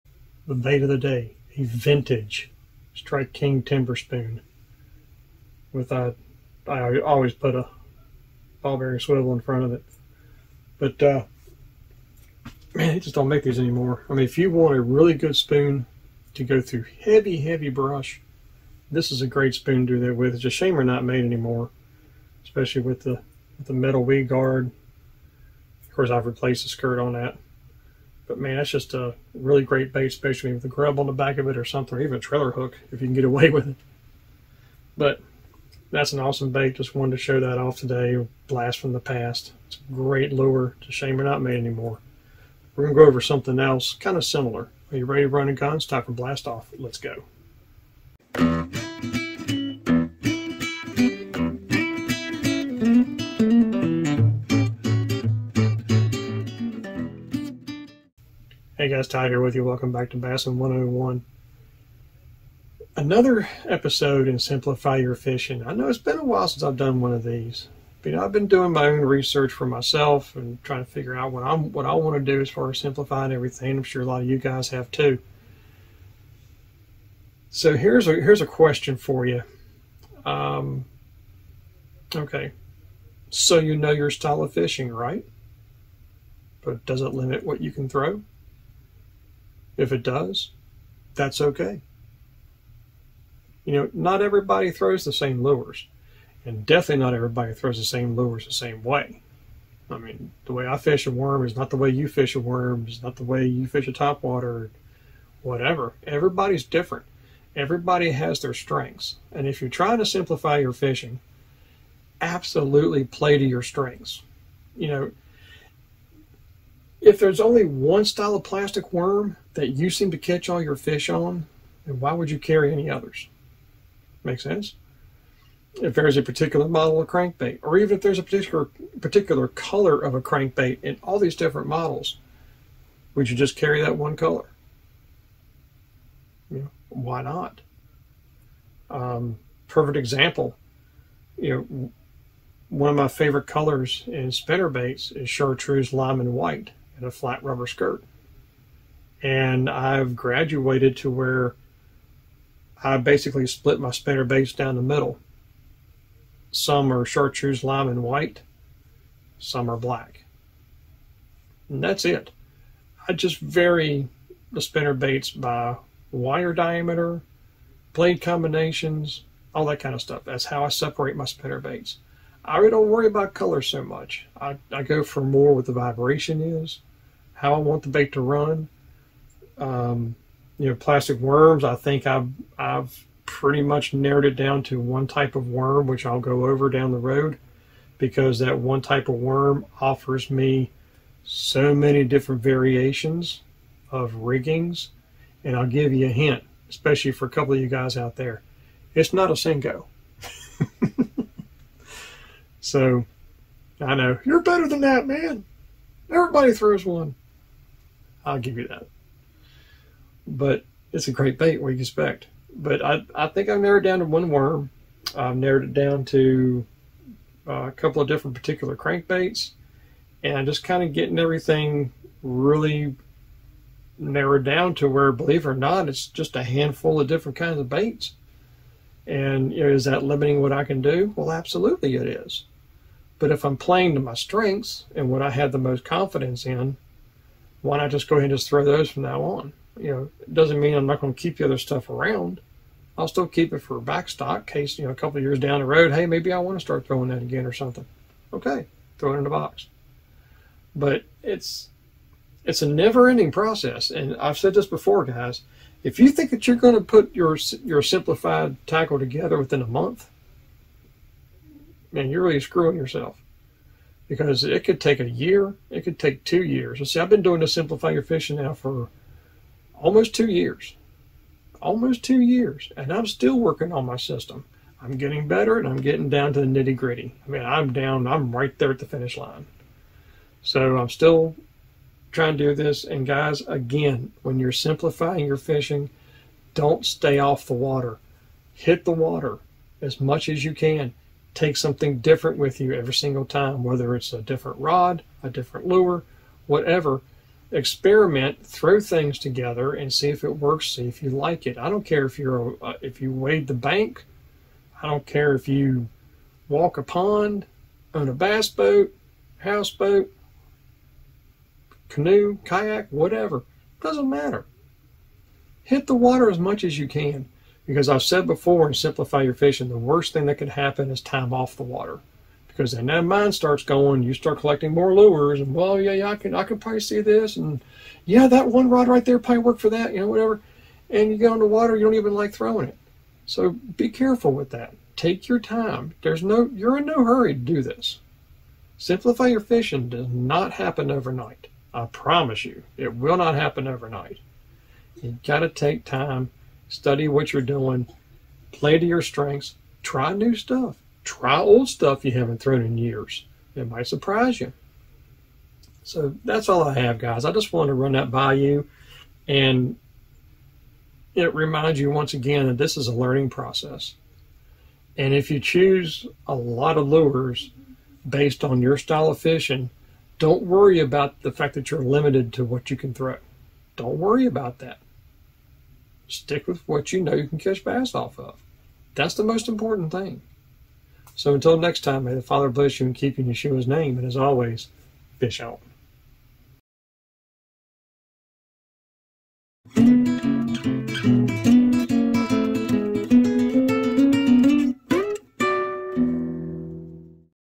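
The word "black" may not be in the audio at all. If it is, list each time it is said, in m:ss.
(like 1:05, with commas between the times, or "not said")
2:39.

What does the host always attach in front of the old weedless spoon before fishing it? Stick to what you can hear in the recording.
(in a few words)
ball bearing swivel.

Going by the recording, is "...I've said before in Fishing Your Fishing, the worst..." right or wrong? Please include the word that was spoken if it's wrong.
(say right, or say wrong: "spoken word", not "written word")
wrong: "Simplify", not "Fishing".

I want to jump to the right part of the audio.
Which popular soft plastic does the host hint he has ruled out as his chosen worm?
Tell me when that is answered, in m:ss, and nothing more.
3:19.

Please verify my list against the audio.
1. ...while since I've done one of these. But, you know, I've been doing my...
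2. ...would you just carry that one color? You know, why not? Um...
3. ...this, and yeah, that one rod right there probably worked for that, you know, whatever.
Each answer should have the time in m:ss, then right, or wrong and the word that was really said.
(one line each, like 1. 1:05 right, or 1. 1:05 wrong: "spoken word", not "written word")
1. 1:06 right
2. 2:13 right
3. 5:27 right.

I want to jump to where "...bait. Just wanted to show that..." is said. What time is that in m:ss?
0:36.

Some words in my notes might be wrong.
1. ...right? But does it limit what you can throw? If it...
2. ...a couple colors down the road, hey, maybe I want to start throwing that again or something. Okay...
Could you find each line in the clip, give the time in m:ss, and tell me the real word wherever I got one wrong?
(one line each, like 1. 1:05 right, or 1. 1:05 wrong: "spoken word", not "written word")
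1. 1:24 right
2. 4:04 wrong: "years", not "colors".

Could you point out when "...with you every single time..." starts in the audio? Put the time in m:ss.
4:52.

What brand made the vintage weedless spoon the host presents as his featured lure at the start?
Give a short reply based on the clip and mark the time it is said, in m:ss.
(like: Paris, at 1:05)
Strike King, at 0:02.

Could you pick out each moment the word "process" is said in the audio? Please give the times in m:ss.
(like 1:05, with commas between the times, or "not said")
4:13, 6:03.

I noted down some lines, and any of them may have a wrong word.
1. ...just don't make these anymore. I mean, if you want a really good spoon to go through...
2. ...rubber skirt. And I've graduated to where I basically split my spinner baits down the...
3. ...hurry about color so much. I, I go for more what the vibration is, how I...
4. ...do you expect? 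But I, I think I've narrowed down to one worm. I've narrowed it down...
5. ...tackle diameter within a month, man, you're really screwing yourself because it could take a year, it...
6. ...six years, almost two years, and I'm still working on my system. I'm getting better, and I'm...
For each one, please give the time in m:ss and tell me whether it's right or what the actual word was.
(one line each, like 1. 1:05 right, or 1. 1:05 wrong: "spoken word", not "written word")
1. 0:12 right
2. 2:27 right
3. 2:52 wrong: "worry", not "hurry"
4. 3:31 right
5. 4:18 wrong: "together", not "diameter"
6. 4:30 wrong: "two", not "six".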